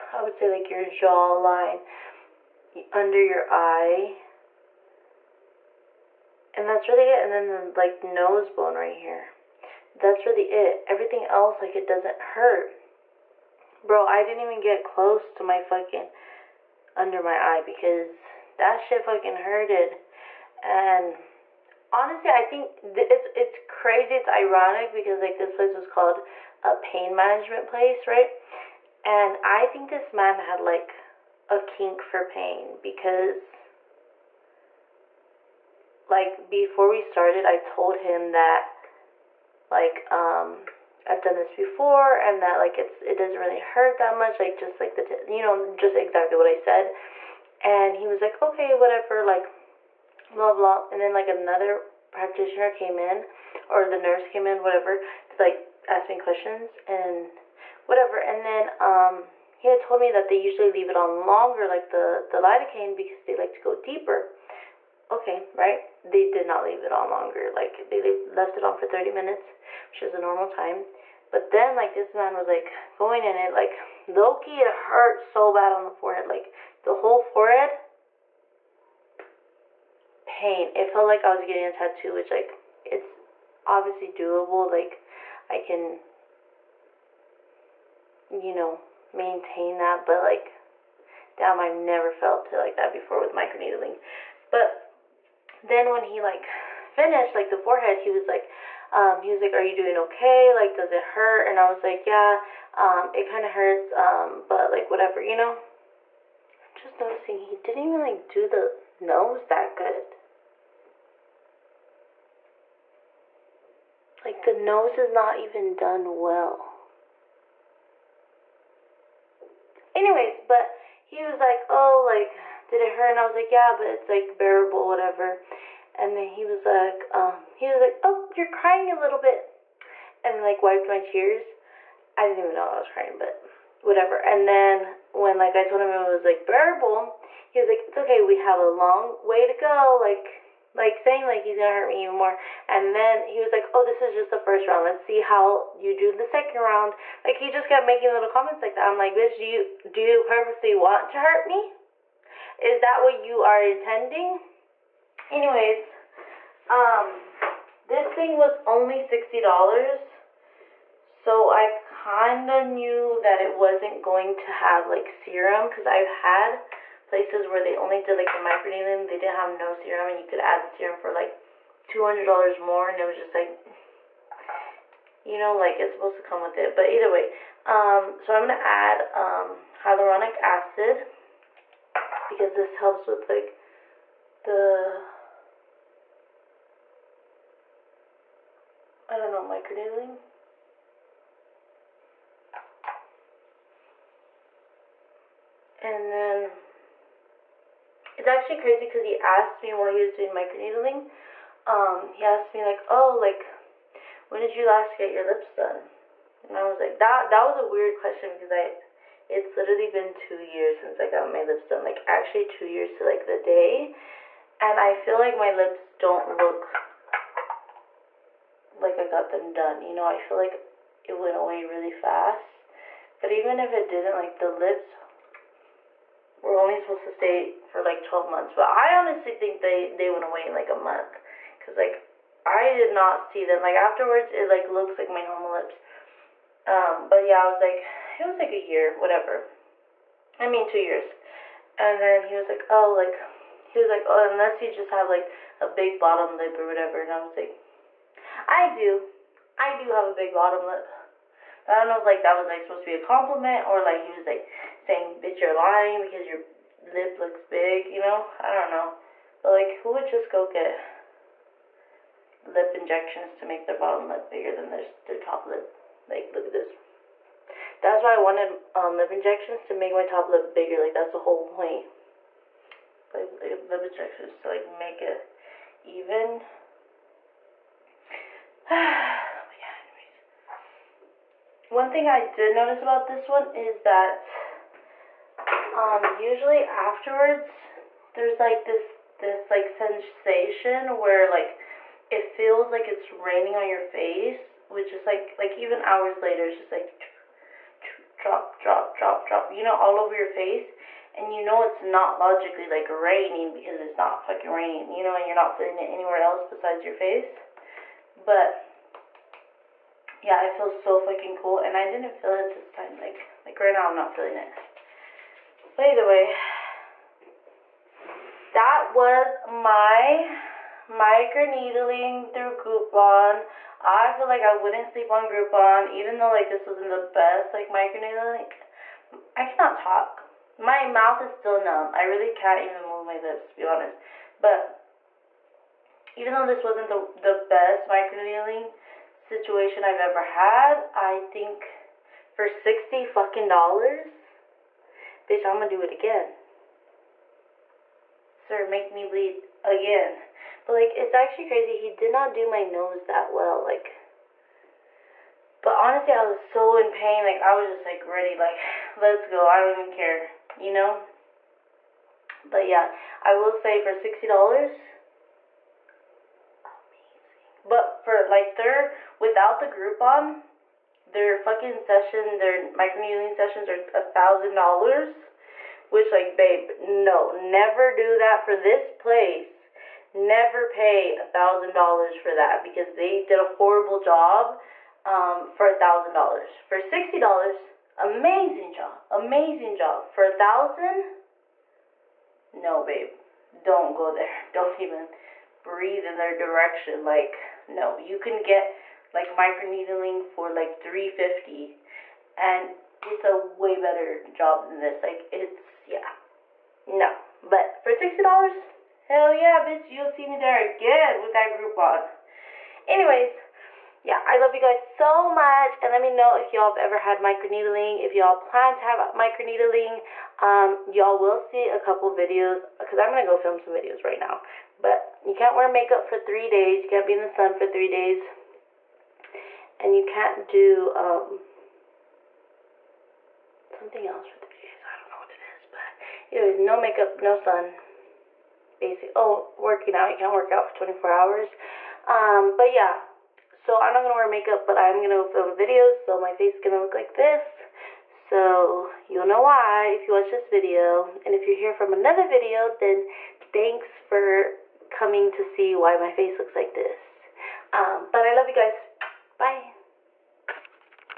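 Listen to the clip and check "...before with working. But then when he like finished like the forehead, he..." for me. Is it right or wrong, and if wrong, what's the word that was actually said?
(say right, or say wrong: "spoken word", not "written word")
wrong: "microneedling", not "working".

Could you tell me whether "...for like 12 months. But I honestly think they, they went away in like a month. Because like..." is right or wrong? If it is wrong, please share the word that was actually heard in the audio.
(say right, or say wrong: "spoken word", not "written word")
right.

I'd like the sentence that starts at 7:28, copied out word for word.
So you'll know why if you watch this video.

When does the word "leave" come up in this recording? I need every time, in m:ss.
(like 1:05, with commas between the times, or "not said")
1:00, 1:06.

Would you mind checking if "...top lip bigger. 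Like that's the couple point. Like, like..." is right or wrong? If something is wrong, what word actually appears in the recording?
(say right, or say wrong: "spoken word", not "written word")
wrong: "whole", not "couple".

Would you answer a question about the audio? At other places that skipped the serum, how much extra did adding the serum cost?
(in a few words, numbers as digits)
$200.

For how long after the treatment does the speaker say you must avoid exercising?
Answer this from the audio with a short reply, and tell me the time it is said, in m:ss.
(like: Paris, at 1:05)
24 hours, at 7:20.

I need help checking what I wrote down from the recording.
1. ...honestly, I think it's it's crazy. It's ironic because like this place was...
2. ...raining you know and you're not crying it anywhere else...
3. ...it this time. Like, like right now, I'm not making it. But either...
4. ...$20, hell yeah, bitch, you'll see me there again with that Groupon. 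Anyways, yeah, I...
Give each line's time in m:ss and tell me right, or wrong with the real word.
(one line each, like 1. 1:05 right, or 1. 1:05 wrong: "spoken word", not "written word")
1. 0:21 right
2. 5:04 wrong: "feeling", not "crying"
3. 5:12 wrong: "feeling", not "making"
4. 6:47 wrong: "60", not "20".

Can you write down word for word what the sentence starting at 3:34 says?
And I feel like my lips don't look like I got them done.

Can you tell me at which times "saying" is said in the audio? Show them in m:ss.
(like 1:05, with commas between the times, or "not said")
2:20, 4:14.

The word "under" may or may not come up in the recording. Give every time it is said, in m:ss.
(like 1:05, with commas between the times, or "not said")
0:02, 0:16.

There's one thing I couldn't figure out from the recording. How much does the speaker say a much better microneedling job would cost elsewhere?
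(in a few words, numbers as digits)
350.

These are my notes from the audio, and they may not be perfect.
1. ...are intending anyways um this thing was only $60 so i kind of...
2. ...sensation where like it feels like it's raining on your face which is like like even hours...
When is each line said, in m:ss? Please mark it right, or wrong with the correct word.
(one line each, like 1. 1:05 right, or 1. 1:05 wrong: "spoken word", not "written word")
1. 2:33 right
2. 4:49 right.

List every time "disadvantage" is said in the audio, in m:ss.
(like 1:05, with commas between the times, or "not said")
not said.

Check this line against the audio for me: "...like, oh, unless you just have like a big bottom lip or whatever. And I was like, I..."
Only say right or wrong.
right.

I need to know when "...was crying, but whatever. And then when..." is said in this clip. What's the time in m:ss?
2:12.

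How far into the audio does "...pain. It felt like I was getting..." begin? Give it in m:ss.
1:20.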